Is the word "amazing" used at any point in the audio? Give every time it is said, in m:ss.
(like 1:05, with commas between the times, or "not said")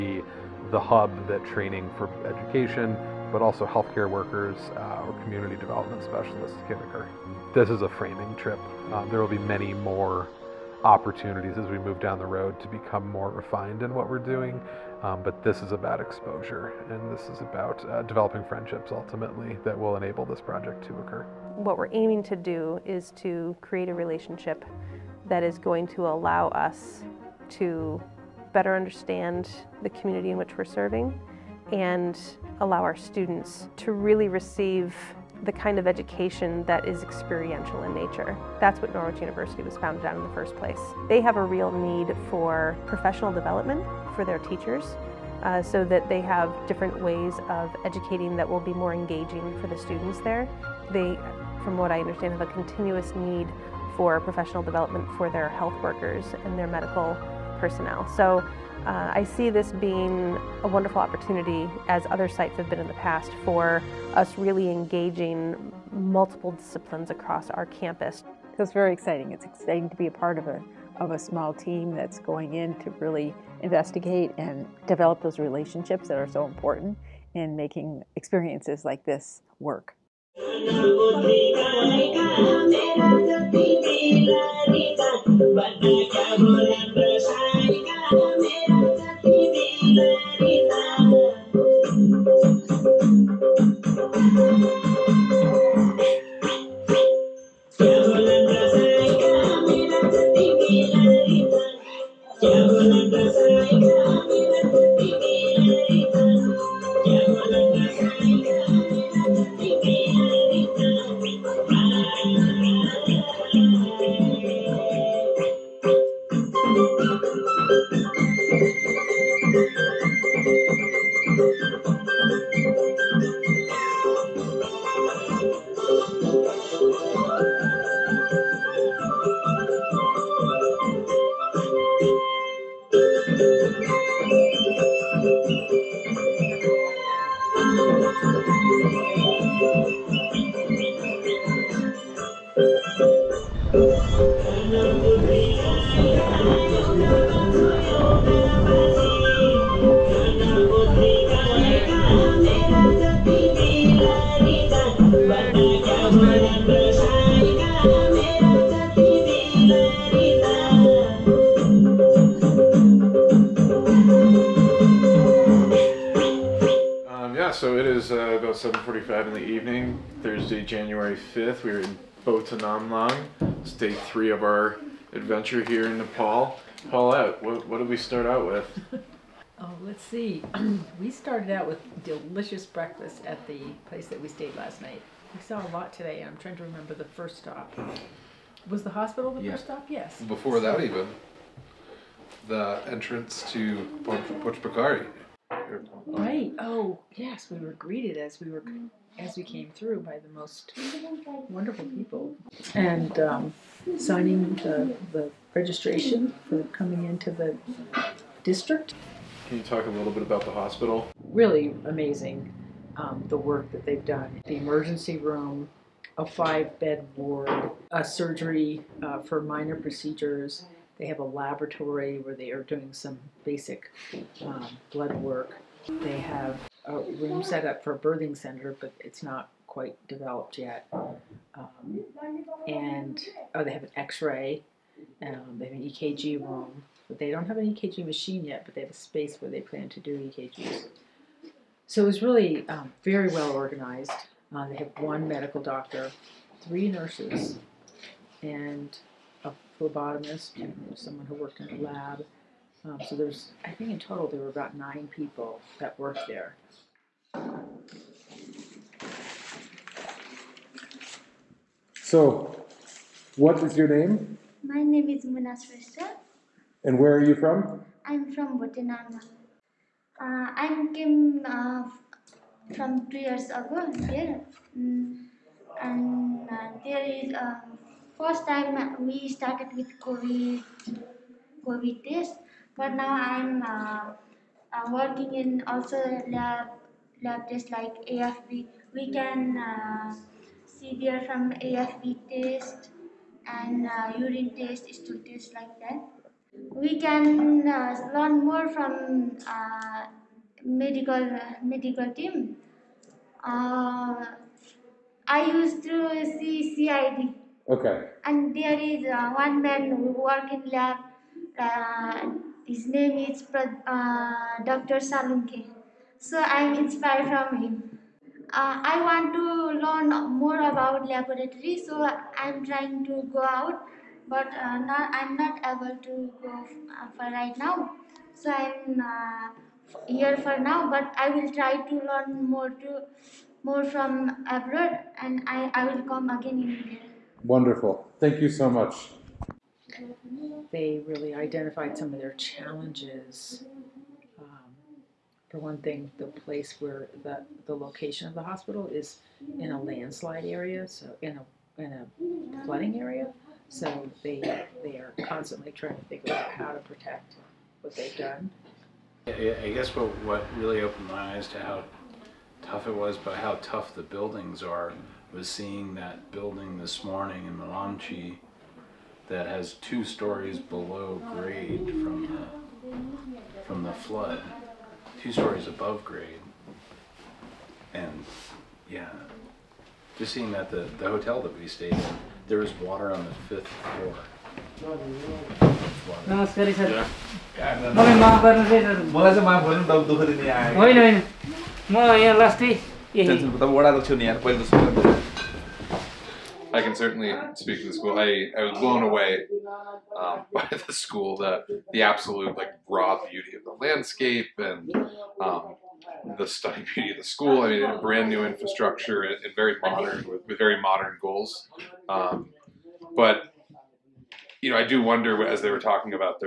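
3:31.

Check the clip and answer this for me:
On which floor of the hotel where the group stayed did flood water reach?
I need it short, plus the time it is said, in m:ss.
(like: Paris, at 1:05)
Fifth floor, at 6:23.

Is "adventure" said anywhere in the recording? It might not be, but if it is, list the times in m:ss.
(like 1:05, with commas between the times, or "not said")
2:55.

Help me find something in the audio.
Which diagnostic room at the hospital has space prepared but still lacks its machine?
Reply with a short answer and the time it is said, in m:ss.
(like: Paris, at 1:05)
EKG room, at 3:55.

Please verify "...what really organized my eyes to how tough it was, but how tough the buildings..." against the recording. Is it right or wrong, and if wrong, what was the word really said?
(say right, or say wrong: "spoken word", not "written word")
wrong: "opened", not "organized".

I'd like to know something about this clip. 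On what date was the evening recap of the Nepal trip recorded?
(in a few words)
Thursday, January 5th.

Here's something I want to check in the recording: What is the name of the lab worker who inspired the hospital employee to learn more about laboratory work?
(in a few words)
Dr. Salunke.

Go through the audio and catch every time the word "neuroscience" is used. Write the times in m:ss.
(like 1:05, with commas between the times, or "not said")
not said.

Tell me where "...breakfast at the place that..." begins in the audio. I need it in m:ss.
3:02.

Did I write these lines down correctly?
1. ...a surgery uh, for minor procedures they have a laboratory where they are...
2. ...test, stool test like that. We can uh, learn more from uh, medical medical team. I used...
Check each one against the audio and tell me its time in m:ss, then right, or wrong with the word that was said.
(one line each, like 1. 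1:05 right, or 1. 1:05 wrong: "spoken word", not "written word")
1. 3:37 right
2. 4:54 right.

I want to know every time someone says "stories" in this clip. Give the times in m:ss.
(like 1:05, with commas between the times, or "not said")
6:10, 6:15.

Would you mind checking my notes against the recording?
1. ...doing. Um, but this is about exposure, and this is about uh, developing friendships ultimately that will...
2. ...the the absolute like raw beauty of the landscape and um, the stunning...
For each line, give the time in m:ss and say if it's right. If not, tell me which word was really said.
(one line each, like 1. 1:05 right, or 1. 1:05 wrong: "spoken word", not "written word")
1. 0:14 right
2. 6:41 right.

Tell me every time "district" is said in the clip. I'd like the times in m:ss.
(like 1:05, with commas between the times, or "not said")
3:28.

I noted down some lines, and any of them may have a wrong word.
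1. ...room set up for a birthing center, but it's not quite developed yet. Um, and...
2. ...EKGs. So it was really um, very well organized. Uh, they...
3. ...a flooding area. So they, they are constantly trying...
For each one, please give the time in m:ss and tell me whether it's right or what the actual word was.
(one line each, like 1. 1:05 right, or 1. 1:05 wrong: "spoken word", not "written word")
1. 3:46 right
2. 4:00 right
3. 5:51 right.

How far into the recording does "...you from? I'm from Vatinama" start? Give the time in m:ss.
4:27.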